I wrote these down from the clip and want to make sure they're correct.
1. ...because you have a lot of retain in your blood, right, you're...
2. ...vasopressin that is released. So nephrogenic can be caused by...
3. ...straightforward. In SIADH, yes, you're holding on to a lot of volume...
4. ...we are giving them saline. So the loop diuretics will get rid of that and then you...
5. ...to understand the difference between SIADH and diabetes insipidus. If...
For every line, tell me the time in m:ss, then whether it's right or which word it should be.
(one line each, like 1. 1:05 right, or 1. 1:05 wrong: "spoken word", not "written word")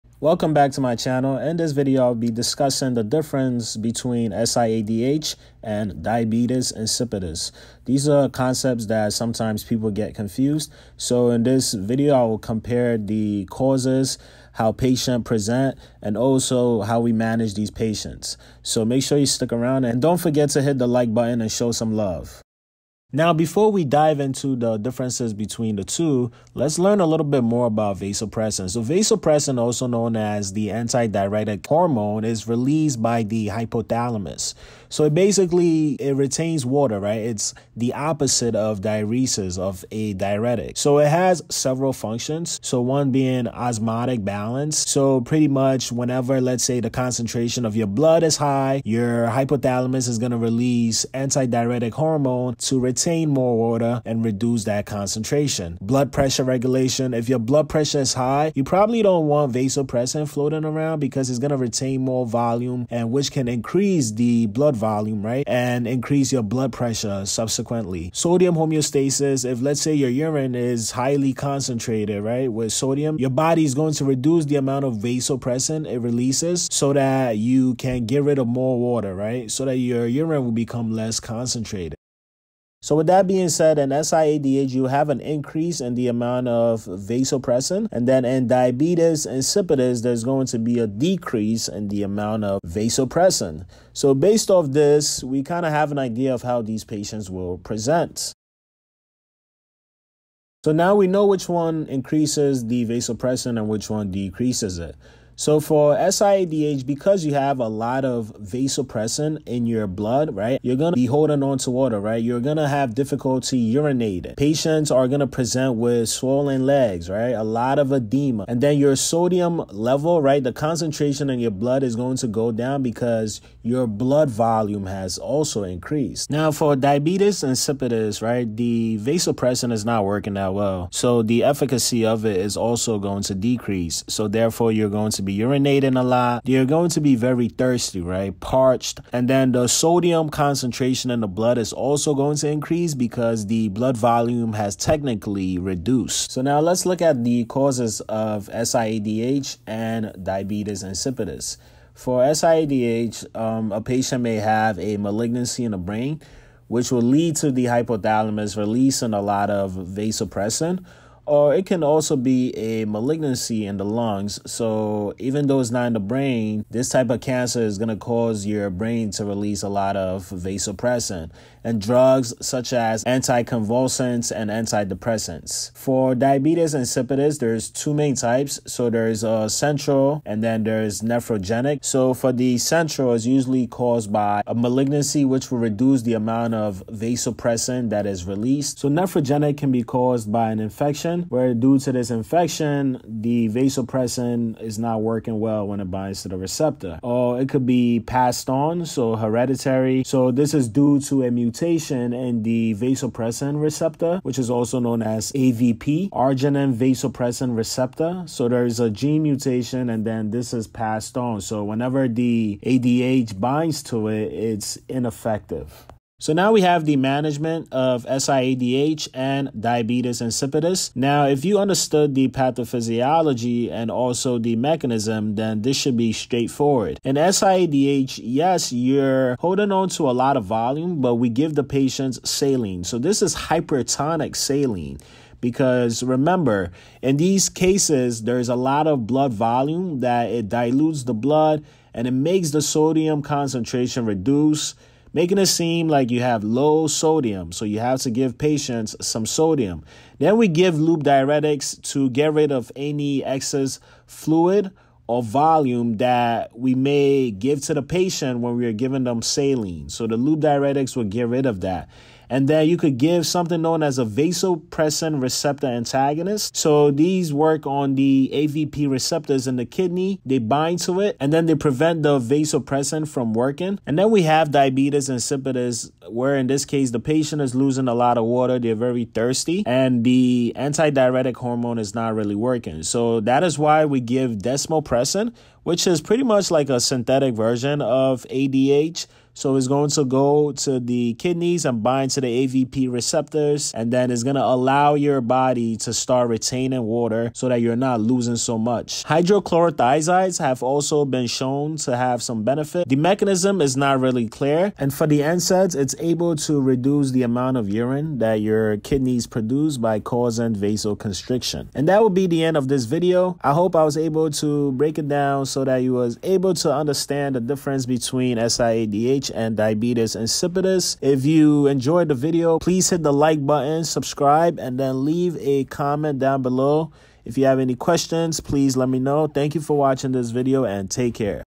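1. 1:46 wrong: "vasopressin", not "retain"
2. 3:06 right
3. 3:46 right
4. 4:18 right
5. 5:16 right.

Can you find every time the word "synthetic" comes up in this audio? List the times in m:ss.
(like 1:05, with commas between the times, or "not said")
4:46.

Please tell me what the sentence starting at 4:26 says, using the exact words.
So these work on the AVP receptors in the kidney, they bind to it, and then they prevent the vasopressin from working.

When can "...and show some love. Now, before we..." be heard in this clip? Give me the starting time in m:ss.
0:21.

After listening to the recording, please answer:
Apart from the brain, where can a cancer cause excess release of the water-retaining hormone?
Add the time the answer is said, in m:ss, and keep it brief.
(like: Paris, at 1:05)
The lungs, at 2:43.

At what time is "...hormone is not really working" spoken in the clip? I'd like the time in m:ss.
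4:41.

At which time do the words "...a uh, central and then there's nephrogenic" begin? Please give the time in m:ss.
2:59.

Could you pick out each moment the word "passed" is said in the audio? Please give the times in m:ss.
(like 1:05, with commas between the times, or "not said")
3:17, 3:30.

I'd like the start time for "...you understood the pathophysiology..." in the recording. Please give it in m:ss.
3:41.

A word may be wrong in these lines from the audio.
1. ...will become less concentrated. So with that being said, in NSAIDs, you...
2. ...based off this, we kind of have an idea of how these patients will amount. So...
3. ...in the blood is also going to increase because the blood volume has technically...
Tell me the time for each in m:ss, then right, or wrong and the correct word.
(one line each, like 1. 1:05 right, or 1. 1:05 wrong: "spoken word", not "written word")
1. 1:20 wrong: "SIADH", not "NSAIDs"
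2. 1:34 wrong: "present", not "amount"
3. 2:21 right.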